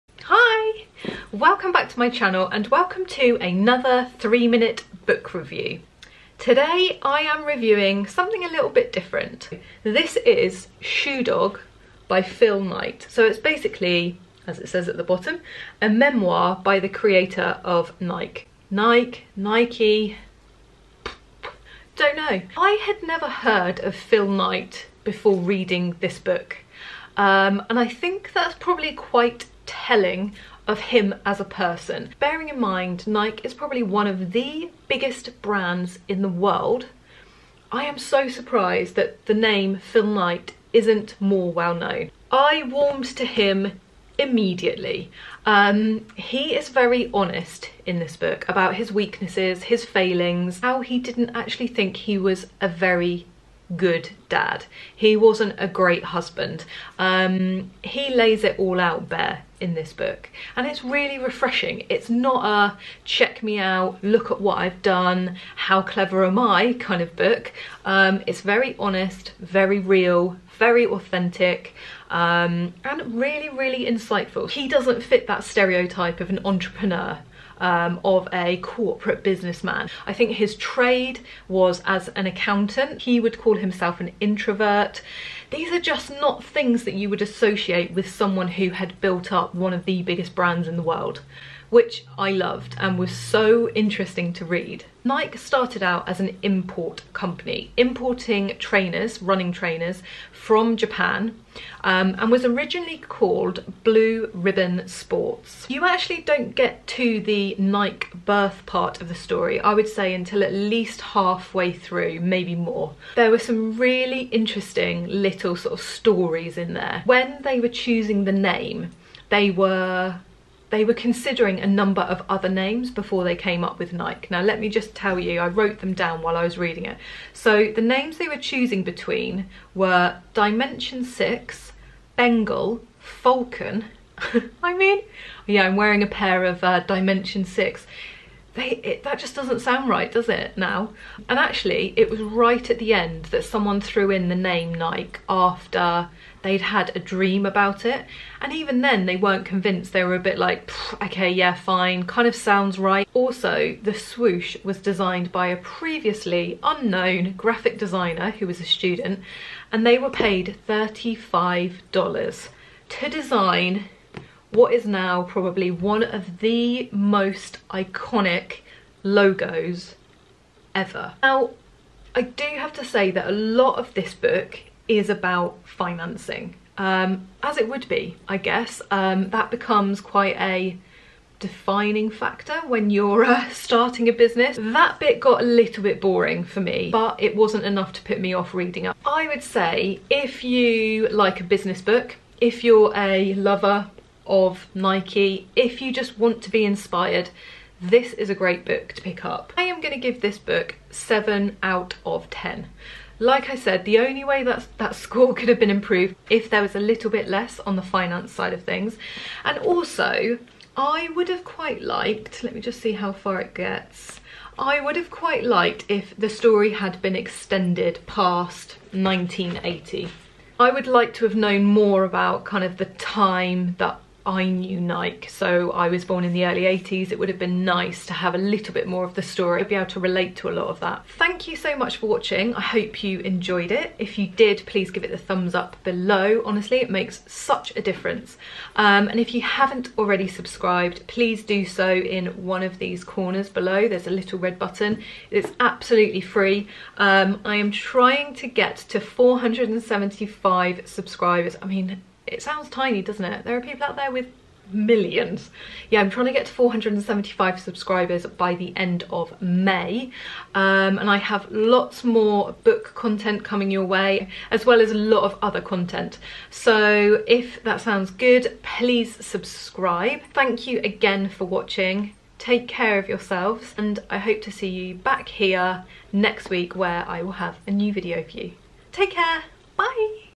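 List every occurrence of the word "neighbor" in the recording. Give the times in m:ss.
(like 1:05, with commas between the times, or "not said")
not said.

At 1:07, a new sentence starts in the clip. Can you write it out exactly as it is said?
Um, it's very honest, very real, very authentic um, and really, really insightful.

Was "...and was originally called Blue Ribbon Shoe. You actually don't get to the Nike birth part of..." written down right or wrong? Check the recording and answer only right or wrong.
wrong.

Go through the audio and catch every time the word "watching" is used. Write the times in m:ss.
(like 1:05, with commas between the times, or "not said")
3:52, 4:31.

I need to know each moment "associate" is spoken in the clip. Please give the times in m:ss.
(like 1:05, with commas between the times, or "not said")
1:27.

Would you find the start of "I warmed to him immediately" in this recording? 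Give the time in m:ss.
0:42.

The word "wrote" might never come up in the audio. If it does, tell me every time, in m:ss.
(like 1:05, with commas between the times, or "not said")
2:05.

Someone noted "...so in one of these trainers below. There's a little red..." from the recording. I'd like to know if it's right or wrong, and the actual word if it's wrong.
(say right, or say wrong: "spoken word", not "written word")
wrong: "corners", not "trainers".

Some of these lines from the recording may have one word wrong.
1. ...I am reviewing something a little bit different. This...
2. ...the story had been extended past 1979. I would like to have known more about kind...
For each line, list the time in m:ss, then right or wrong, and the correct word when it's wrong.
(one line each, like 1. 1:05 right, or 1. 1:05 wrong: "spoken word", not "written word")
1. 0:07 right
2. 3:36 wrong: "1980", not "1979".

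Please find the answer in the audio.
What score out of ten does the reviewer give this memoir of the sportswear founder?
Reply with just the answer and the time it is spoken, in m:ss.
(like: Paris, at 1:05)
7, at 3:20.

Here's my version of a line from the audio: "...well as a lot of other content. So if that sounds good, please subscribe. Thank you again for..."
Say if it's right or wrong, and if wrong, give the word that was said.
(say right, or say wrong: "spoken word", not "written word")
right.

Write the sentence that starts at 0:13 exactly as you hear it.
So it's basically, as it says at the bottom, a memoir by the creator of Nike.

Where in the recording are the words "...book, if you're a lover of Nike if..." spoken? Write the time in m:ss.
3:11.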